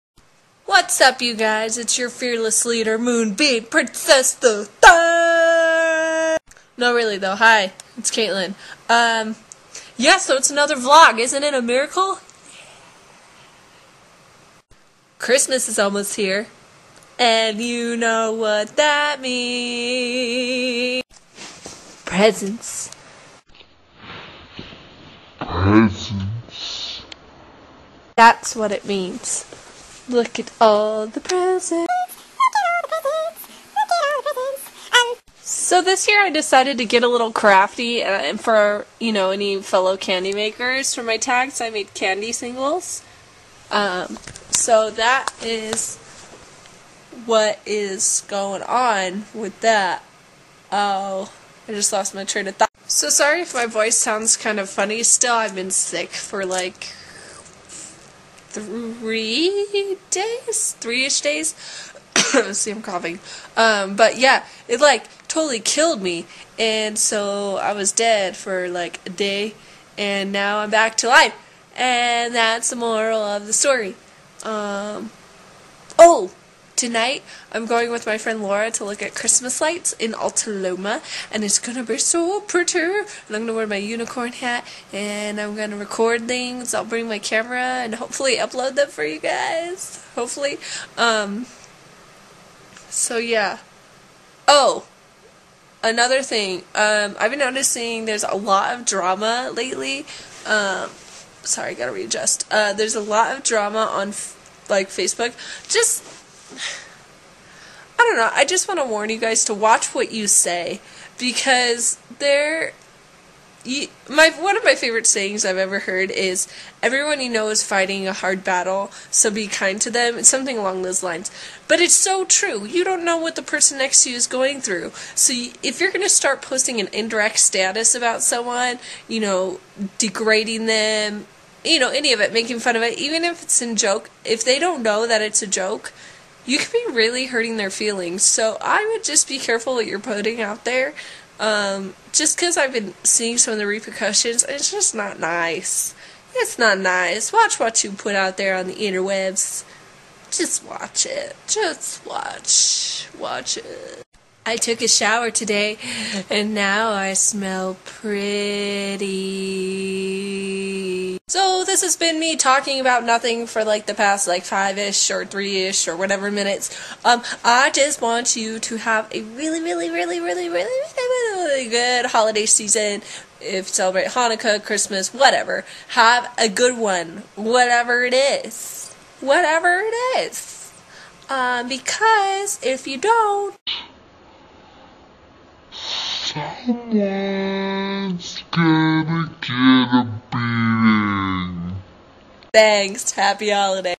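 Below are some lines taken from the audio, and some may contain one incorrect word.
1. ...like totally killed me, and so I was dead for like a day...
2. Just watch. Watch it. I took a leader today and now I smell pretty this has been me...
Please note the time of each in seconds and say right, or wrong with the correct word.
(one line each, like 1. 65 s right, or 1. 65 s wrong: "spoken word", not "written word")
1. 64 s right
2. 151 s wrong: "shower", not "leader".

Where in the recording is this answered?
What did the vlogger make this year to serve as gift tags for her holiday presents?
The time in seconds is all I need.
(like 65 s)
41 s.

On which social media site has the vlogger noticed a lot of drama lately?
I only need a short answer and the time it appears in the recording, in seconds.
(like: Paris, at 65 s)
Facebook, at 104 s.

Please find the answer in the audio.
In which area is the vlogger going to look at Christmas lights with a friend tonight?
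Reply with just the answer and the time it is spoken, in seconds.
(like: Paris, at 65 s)
Alta Loma, at 80 s.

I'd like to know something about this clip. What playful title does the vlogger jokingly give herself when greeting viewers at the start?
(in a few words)
Moonbeam Princess the Third.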